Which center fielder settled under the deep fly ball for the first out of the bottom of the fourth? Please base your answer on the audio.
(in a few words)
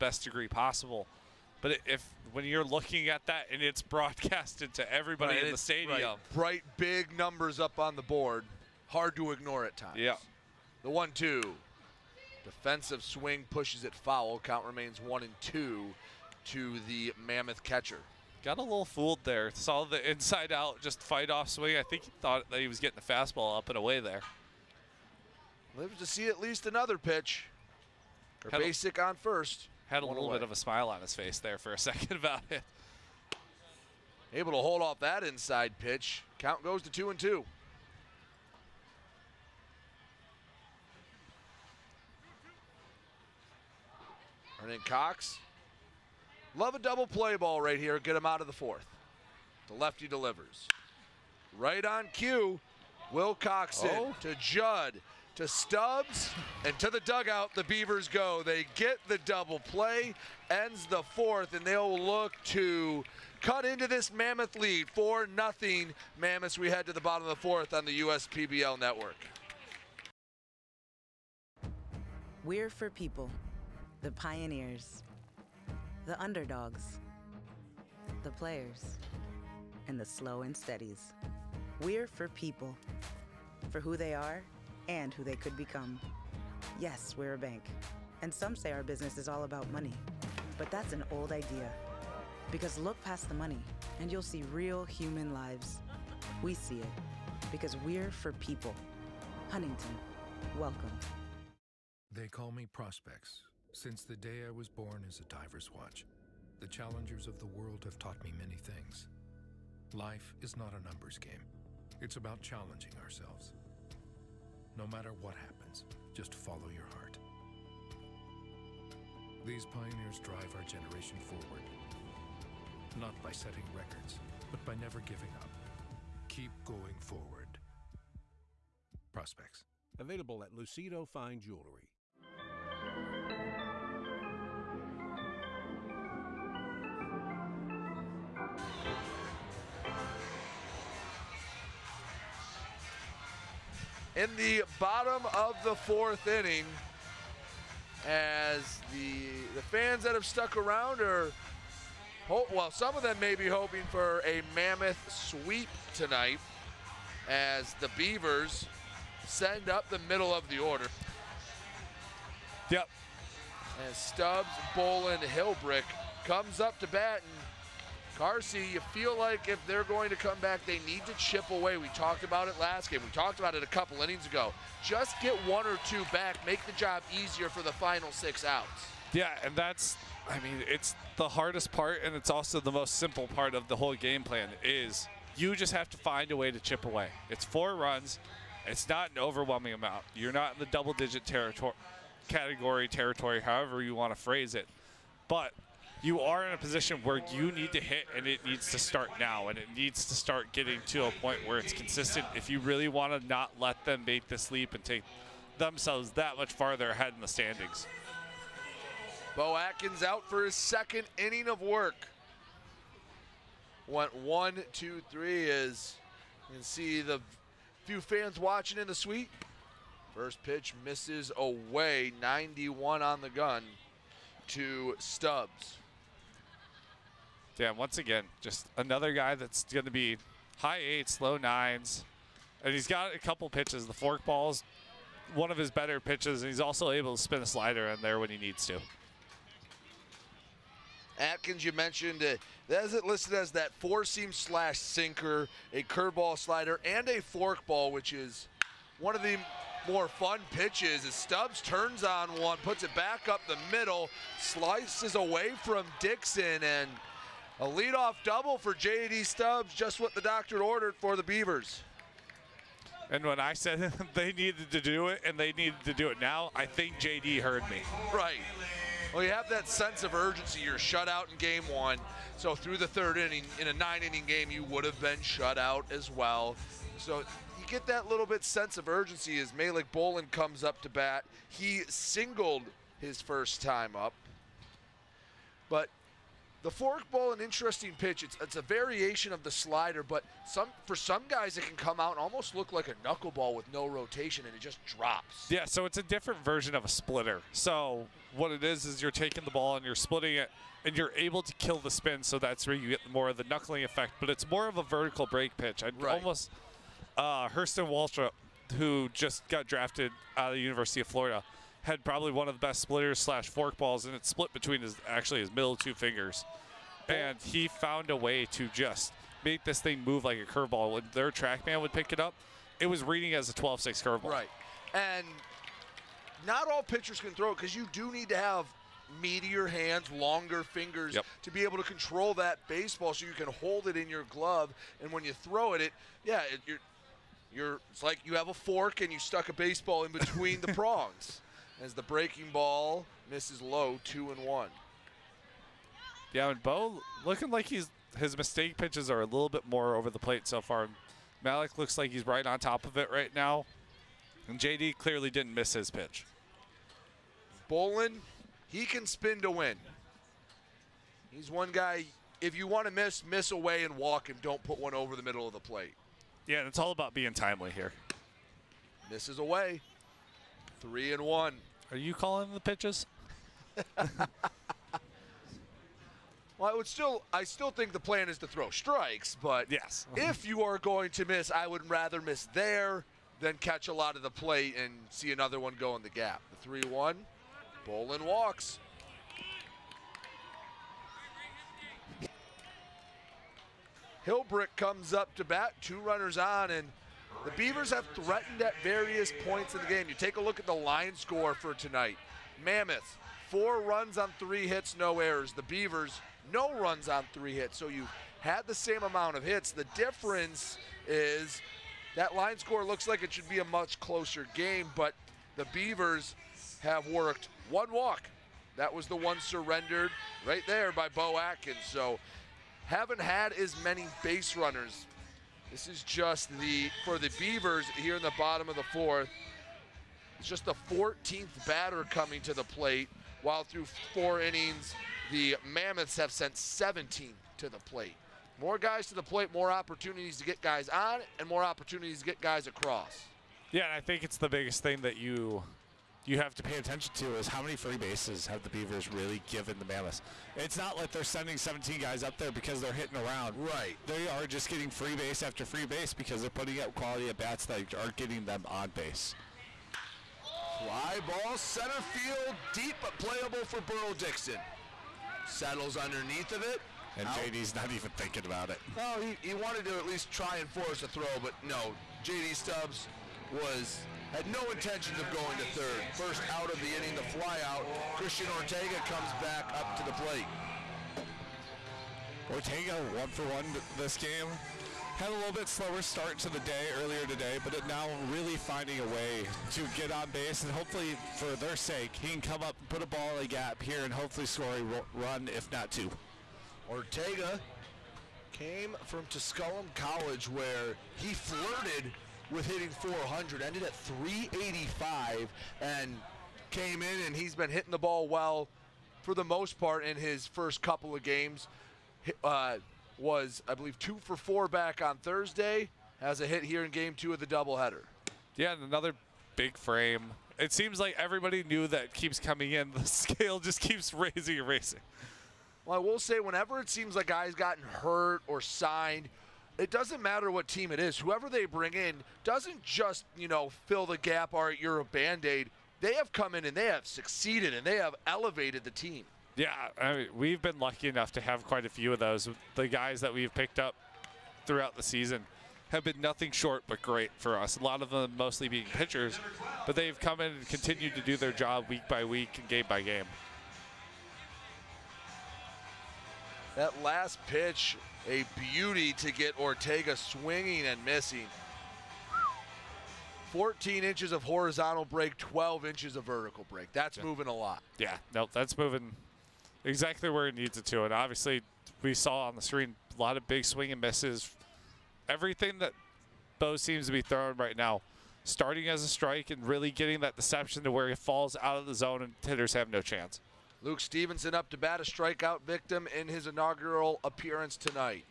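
Burl Dixon.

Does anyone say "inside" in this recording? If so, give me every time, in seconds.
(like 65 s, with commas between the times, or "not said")
20 s, 35 s.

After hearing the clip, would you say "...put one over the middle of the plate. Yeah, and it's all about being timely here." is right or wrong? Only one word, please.
right.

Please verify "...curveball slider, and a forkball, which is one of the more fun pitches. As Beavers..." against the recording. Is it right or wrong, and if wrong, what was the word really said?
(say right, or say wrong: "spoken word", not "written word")
wrong: "Stubbs", not "Beavers".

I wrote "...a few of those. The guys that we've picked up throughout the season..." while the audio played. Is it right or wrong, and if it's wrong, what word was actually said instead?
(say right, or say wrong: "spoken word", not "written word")
right.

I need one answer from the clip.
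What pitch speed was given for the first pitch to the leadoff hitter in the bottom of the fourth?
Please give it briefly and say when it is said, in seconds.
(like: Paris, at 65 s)
91, at 222 s.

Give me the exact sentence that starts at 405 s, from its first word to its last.
The Beavers, no runs on three hits.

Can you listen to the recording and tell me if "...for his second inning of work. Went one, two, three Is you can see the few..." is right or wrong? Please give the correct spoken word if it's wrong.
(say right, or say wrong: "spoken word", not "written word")
right.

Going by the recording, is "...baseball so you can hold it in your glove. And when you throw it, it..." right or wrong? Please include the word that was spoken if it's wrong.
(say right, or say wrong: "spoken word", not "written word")
right.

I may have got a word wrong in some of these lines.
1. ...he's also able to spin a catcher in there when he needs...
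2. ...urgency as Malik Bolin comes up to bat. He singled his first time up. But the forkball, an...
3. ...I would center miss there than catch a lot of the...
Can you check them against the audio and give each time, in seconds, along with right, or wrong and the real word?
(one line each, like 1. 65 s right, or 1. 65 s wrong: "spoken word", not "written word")
1. 236 s wrong: "slider", not "catcher"
2. 278 s right
3. 381 s wrong: "rather", not "center".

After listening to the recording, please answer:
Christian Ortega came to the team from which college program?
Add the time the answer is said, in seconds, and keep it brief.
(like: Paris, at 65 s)
Tusculum College, at 499 s.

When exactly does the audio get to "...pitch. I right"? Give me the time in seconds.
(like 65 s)
305 s.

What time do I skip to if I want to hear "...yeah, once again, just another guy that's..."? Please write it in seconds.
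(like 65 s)
227 s.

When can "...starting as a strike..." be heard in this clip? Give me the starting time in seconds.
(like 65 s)
578 s.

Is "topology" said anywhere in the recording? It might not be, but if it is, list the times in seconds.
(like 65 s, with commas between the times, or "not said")
not said.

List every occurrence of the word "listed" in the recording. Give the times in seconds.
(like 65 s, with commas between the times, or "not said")
243 s.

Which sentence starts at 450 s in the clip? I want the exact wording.
It's not like they're sending 17 guys up there because they're hitting around.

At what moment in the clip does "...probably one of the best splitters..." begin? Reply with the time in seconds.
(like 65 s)
312 s.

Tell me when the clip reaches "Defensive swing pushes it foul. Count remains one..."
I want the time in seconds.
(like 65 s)
12 s.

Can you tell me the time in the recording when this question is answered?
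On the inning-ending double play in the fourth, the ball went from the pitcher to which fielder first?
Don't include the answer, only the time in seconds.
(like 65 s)
54 s.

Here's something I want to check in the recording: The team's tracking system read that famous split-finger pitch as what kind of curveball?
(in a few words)
12-6 curveball.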